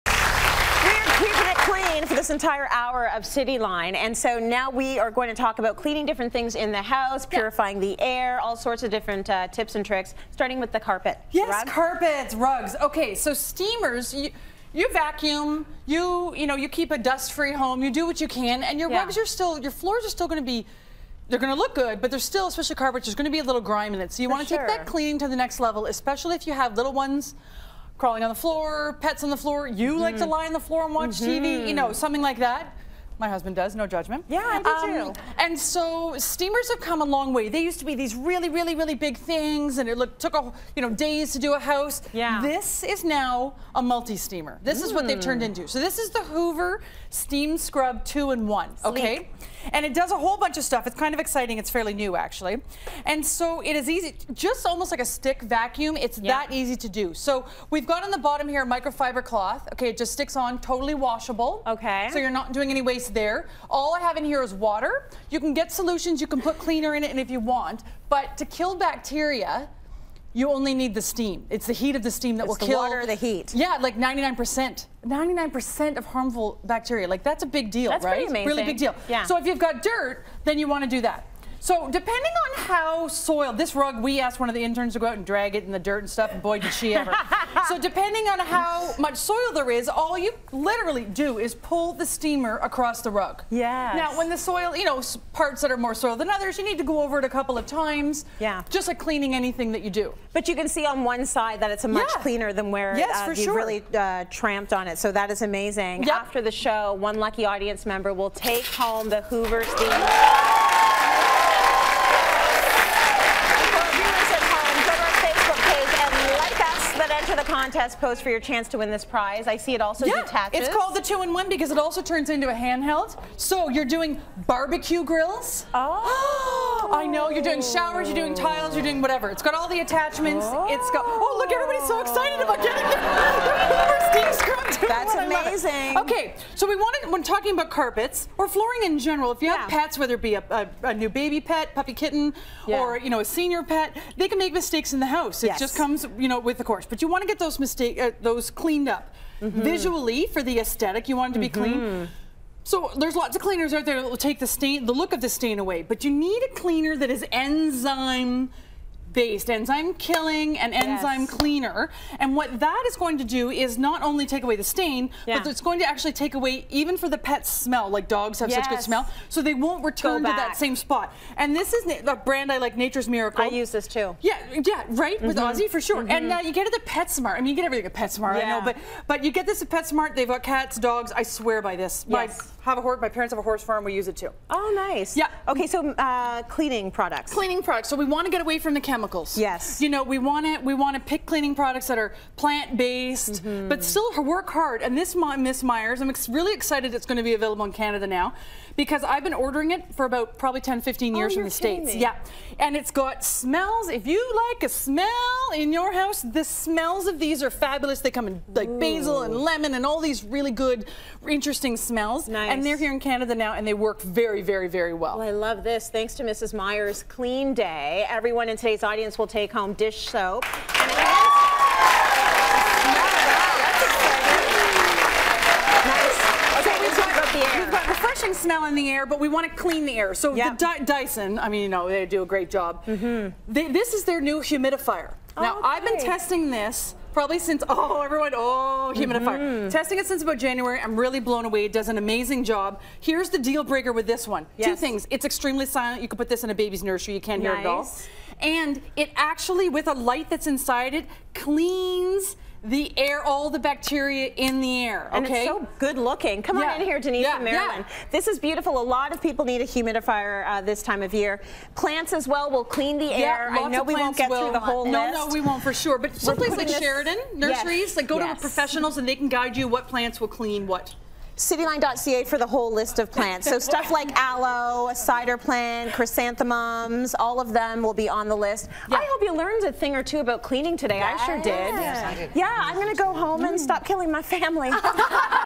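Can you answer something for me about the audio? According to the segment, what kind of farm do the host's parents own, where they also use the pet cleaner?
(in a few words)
horse farm.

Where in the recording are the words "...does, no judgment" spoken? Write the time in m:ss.
0:33.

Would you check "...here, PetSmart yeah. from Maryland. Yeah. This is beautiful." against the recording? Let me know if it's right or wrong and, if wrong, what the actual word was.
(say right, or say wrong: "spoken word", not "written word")
wrong: "Denise", not "PetSmart".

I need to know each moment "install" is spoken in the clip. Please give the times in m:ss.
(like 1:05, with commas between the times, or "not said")
not said.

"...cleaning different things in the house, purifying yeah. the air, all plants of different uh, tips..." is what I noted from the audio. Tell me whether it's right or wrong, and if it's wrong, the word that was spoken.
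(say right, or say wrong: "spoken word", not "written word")
wrong: "sorts", not "plants".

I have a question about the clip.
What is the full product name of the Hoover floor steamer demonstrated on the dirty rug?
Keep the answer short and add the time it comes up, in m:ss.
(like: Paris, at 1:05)
Hoover Steam Scrub 2-in-1, at 0:46.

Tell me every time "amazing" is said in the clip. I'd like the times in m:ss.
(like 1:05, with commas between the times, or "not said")
1:18, 1:45, 2:15, 4:01.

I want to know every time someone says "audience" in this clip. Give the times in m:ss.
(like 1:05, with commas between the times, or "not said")
1:47, 3:38.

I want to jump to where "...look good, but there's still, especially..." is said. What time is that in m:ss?
0:21.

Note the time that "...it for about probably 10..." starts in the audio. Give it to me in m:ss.
3:19.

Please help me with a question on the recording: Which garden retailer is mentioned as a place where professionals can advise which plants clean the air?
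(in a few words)
Sheridan Nurseries.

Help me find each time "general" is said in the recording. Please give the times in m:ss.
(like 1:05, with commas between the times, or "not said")
2:18.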